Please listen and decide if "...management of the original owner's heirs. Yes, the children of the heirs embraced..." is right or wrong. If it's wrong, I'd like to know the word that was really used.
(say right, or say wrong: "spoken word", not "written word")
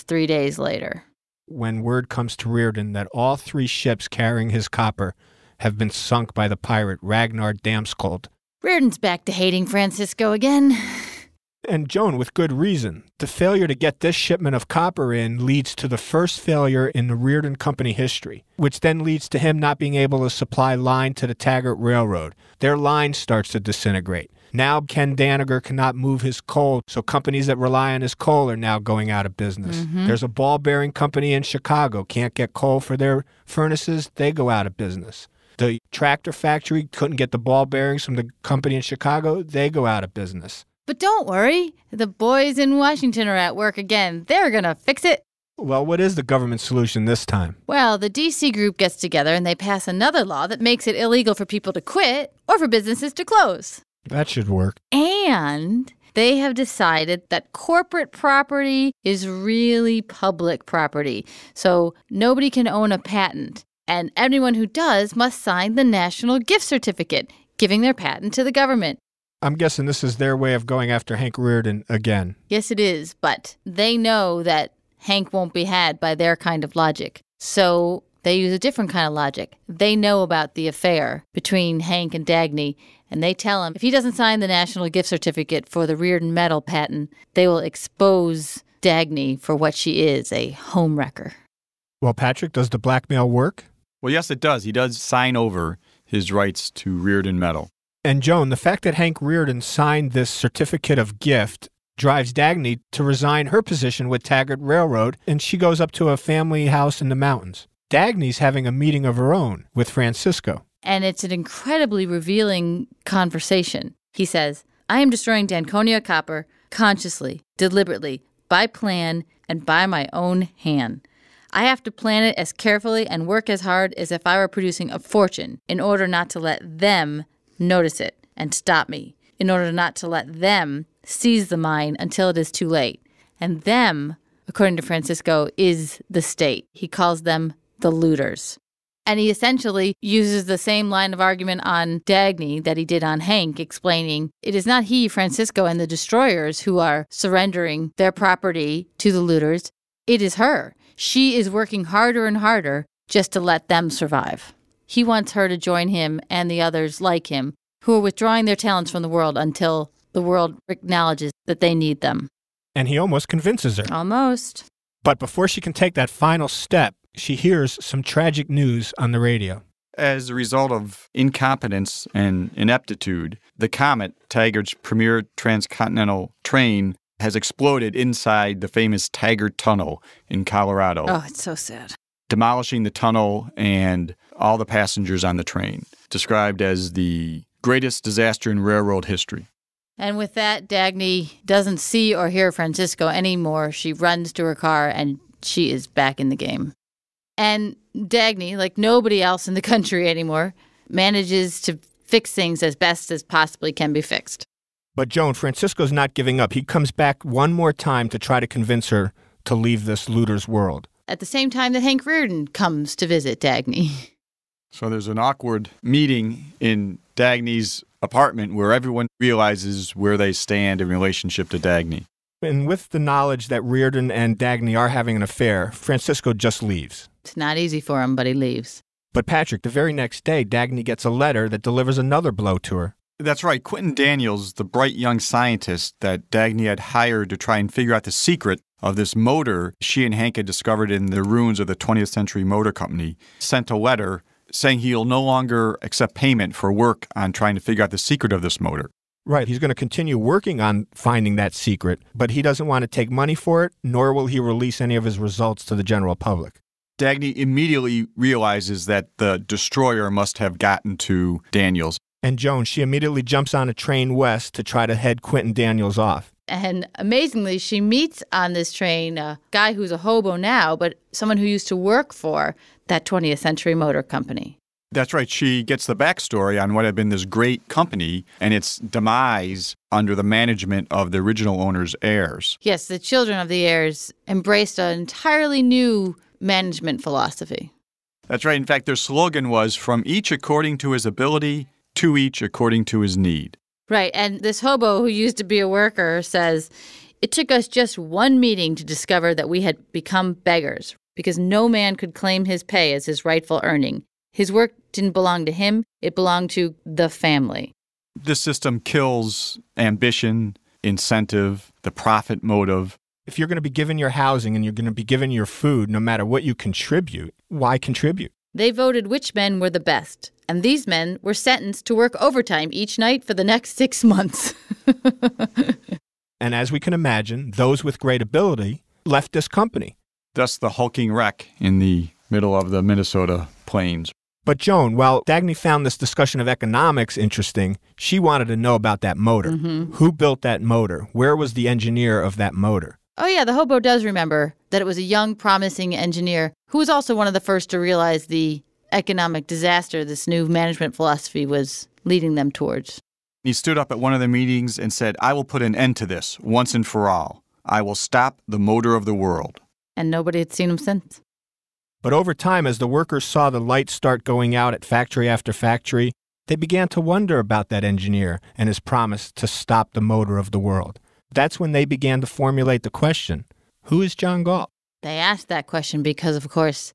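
right.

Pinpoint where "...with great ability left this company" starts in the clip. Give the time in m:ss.
5:27.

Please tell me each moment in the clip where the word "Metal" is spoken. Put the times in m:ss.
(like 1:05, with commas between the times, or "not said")
1:26, 1:37.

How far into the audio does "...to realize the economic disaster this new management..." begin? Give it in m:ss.
5:47.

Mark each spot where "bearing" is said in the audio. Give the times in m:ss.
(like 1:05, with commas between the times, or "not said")
0:30, 0:37.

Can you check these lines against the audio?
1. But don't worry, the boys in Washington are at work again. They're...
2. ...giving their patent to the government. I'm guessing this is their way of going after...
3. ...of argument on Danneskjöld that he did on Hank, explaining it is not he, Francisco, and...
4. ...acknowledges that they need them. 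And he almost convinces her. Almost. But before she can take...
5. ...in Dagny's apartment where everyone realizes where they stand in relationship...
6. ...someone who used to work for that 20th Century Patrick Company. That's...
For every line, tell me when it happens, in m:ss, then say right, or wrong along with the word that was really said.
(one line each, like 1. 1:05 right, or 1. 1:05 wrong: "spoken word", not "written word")
1. 0:40 right
2. 1:07 right
3. 2:21 wrong: "Dagny", not "Danneskjöld"
4. 2:40 right
5. 3:36 right
6. 4:31 wrong: "Motor", not "Patrick".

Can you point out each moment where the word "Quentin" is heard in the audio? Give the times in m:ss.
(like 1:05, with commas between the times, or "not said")
3:53, 4:25.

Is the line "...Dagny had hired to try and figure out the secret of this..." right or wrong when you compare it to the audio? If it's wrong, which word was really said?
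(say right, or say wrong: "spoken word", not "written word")
right.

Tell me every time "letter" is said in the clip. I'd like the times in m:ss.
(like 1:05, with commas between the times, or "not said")
3:51, 4:03.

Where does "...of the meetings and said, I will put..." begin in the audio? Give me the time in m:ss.
5:54.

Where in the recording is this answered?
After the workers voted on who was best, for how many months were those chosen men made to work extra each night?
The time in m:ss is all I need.
5:23.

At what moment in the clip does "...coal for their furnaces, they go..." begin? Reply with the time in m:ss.
0:32.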